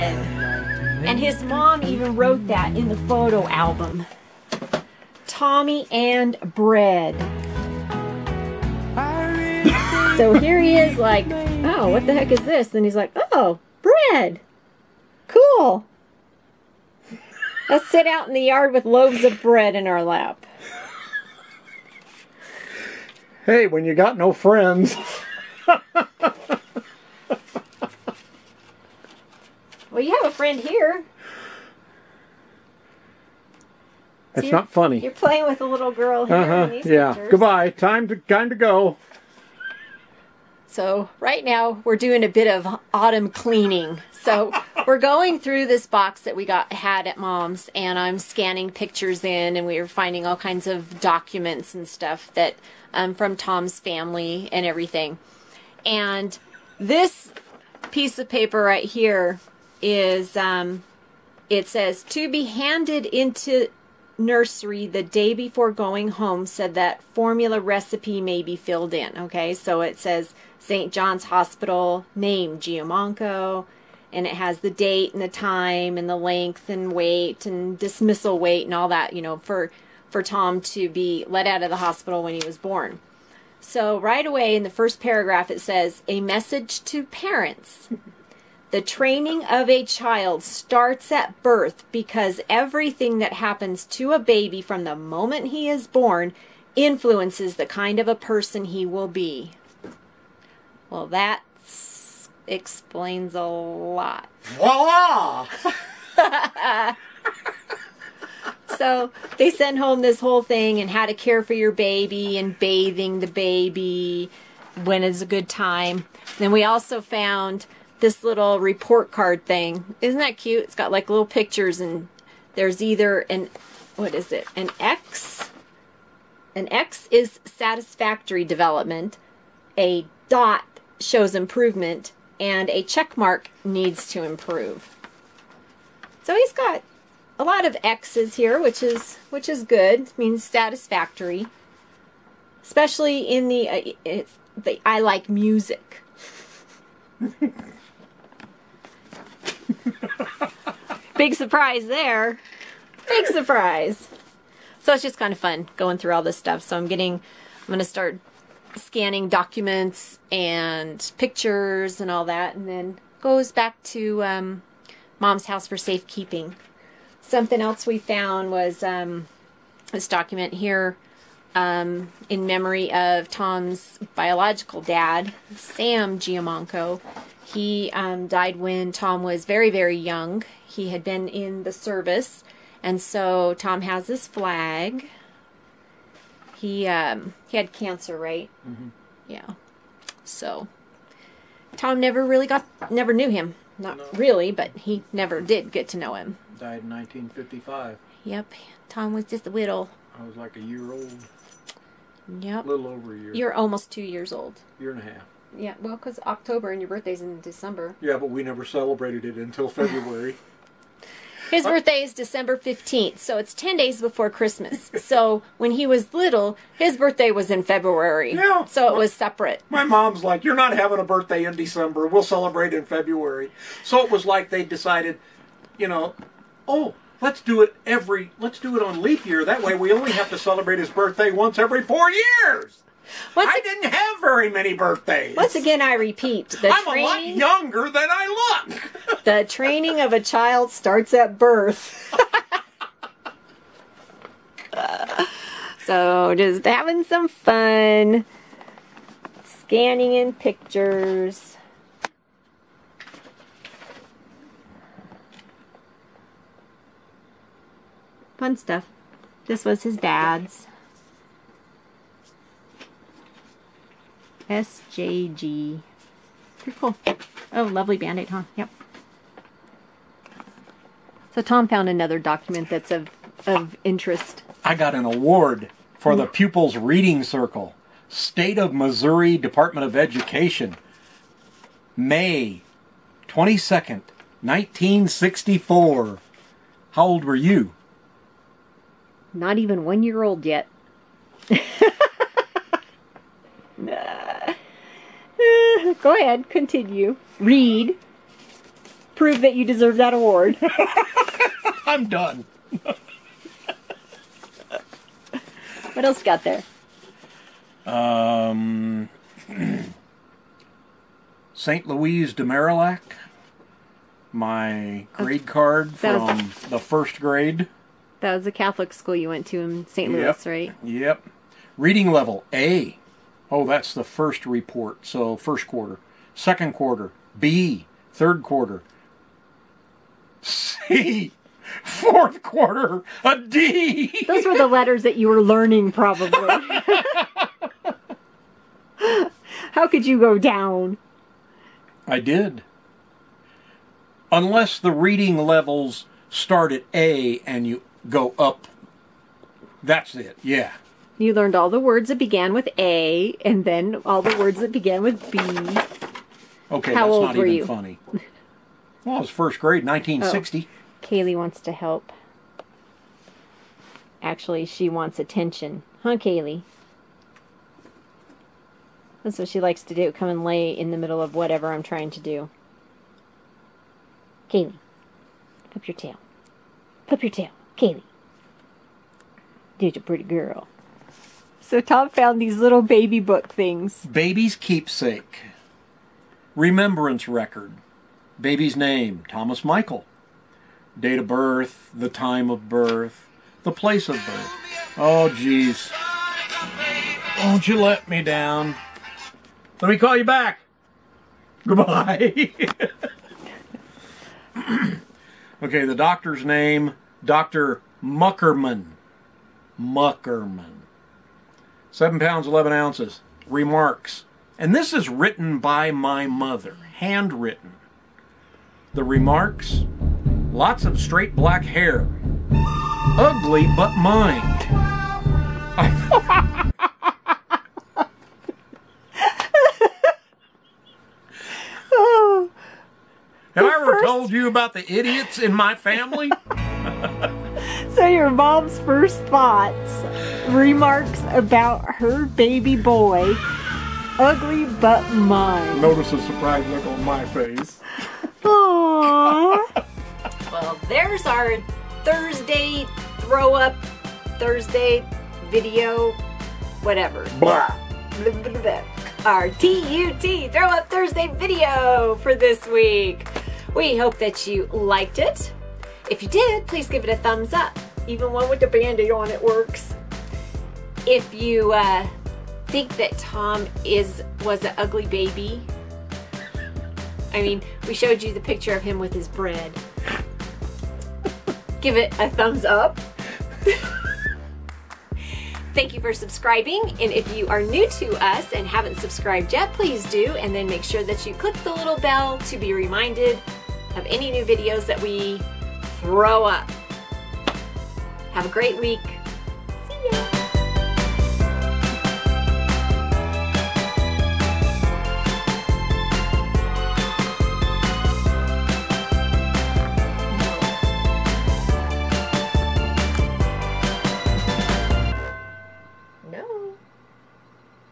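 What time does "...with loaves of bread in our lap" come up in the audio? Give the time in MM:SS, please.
00:18.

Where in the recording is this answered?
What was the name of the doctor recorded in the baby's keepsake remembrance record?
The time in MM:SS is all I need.
06:47.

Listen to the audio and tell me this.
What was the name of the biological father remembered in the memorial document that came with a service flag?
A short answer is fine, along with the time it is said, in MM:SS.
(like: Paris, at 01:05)
Sam Giamanco, at 02:55.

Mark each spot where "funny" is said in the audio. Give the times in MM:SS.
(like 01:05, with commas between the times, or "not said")
00:34, 05:57.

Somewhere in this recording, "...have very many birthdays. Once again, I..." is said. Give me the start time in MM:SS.
03:53.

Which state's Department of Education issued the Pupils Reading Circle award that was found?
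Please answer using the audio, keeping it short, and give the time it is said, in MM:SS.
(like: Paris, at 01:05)
Missouri, at 04:38.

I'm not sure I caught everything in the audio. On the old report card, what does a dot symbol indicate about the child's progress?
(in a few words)
Improvement.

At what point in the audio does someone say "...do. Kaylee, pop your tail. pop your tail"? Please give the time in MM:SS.
06:12.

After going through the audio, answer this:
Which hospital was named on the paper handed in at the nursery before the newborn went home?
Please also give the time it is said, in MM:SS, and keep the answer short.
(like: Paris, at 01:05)
St. John's Hospital, at 01:10.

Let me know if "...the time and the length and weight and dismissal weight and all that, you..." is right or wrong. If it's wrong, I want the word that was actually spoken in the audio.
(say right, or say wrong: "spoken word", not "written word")
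right.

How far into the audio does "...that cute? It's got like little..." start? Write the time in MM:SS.
02:00.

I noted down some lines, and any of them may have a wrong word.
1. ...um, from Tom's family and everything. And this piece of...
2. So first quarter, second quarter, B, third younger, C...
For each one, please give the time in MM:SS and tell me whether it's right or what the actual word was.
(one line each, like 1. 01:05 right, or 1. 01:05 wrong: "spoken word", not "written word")
1. 00:52 right
2. 05:25 wrong: "quarter", not "younger".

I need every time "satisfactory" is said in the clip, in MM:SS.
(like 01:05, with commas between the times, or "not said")
02:07, 02:20.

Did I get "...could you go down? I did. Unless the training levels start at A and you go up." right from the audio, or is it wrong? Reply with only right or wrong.
wrong.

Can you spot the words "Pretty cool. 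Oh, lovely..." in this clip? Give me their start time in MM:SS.
04:26.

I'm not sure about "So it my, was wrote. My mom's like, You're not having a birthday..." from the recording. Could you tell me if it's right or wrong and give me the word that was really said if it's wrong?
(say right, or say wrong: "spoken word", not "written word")
wrong: "separate", not "wrote".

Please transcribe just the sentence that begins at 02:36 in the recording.
So I'm getting, I'm going to start scanning documents and pictures and all that.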